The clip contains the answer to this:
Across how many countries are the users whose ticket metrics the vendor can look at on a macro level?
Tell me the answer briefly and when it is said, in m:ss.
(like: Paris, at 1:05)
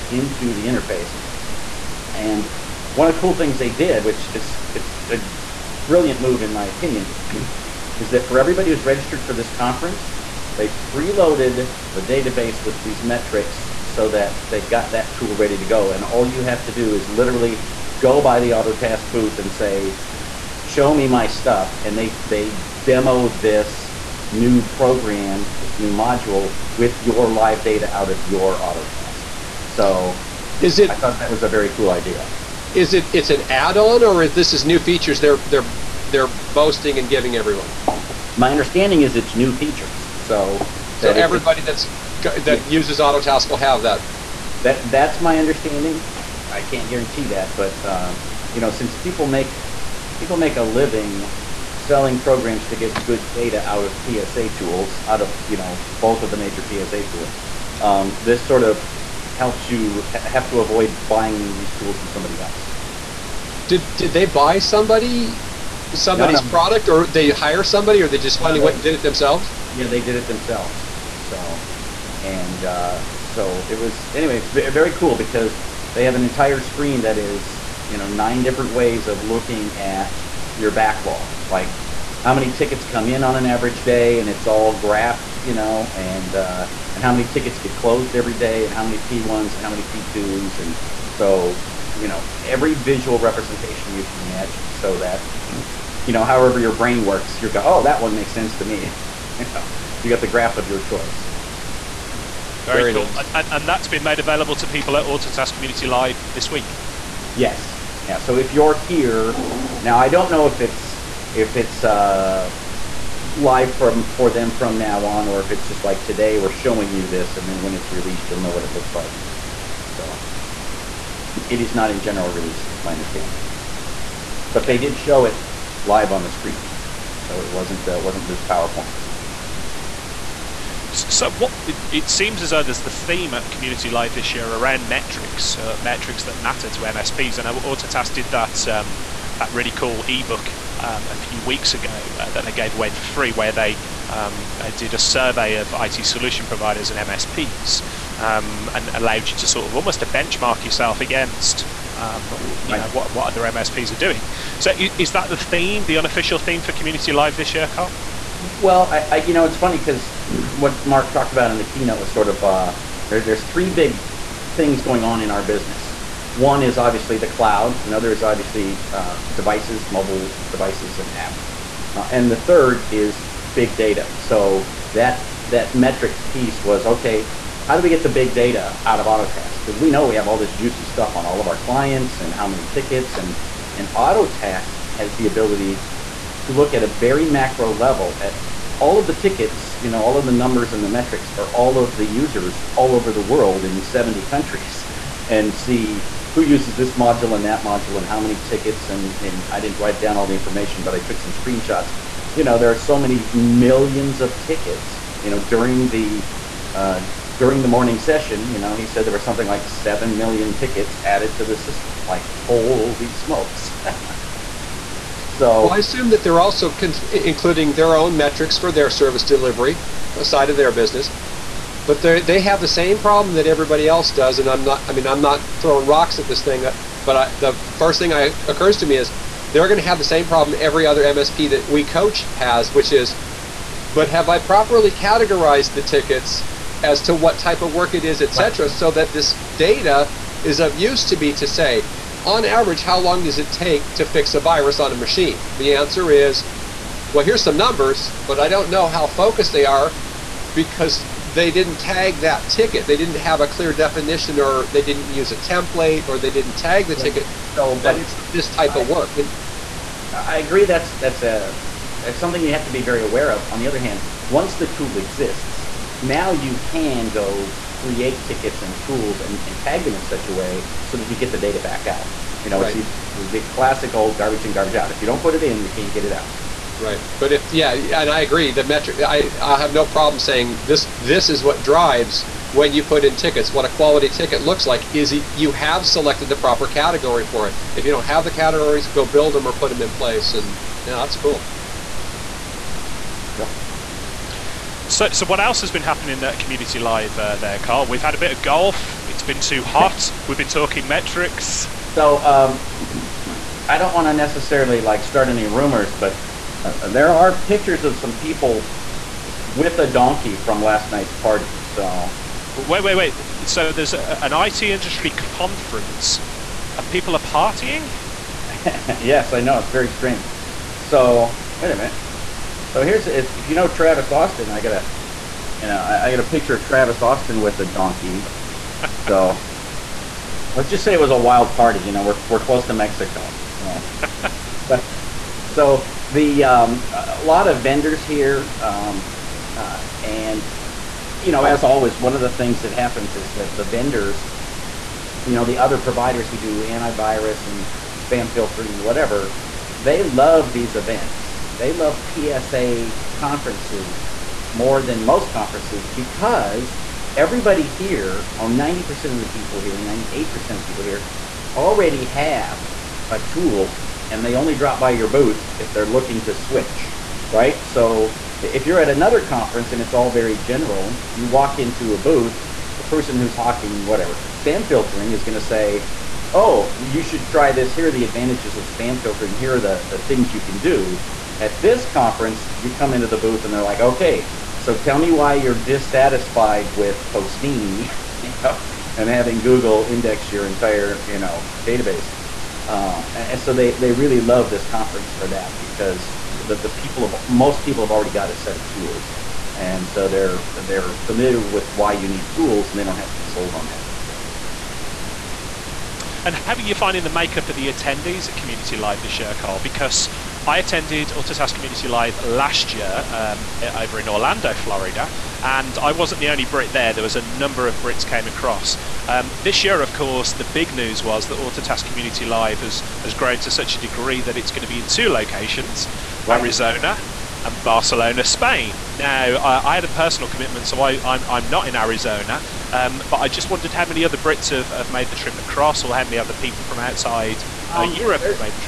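70, at 3:13.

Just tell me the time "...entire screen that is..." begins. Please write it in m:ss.
1:16.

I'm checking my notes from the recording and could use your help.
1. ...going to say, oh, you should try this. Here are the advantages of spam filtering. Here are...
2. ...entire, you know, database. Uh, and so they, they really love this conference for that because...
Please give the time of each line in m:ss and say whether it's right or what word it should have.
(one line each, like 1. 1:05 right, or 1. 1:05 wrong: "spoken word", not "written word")
1. 6:15 right
2. 6:30 right.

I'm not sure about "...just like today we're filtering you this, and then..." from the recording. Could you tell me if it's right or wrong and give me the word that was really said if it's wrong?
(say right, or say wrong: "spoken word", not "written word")
wrong: "showing", not "filtering".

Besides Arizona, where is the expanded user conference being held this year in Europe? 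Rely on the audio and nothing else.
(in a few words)
Barcelona, Spain.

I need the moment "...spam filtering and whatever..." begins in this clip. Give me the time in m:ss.
5:48.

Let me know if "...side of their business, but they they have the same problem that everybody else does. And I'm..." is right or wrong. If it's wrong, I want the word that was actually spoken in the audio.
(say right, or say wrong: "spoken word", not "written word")
right.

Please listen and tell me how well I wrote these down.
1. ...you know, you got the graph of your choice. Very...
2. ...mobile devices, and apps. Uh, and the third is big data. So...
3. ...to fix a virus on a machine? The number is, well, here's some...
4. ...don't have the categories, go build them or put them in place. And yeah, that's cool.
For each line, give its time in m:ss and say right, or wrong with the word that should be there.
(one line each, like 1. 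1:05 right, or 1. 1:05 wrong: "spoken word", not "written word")
1. 1:39 right
2. 2:49 right
3. 4:03 wrong: "answer", not "number"
4. 4:47 right.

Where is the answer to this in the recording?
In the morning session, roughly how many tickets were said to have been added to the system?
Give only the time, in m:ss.
3:29.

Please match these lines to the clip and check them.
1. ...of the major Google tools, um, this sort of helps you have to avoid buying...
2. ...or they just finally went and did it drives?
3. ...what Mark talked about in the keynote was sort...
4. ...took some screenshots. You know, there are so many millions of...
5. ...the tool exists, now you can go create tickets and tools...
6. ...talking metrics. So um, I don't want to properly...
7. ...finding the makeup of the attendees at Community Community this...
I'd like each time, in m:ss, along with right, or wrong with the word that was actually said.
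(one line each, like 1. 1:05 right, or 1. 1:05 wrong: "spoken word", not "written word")
1. 0:56 wrong: "PSA", not "Google"
2. 1:08 wrong: "themselves", not "drives"
3. 2:40 right
4. 3:20 right
5. 4:24 right
6. 5:00 wrong: "necessarily", not "properly"
7. 6:46 wrong: "Live", not "Community".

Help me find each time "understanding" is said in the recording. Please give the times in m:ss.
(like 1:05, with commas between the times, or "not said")
0:38, 0:45, 2:02.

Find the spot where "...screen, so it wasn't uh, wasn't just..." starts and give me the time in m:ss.
2:06.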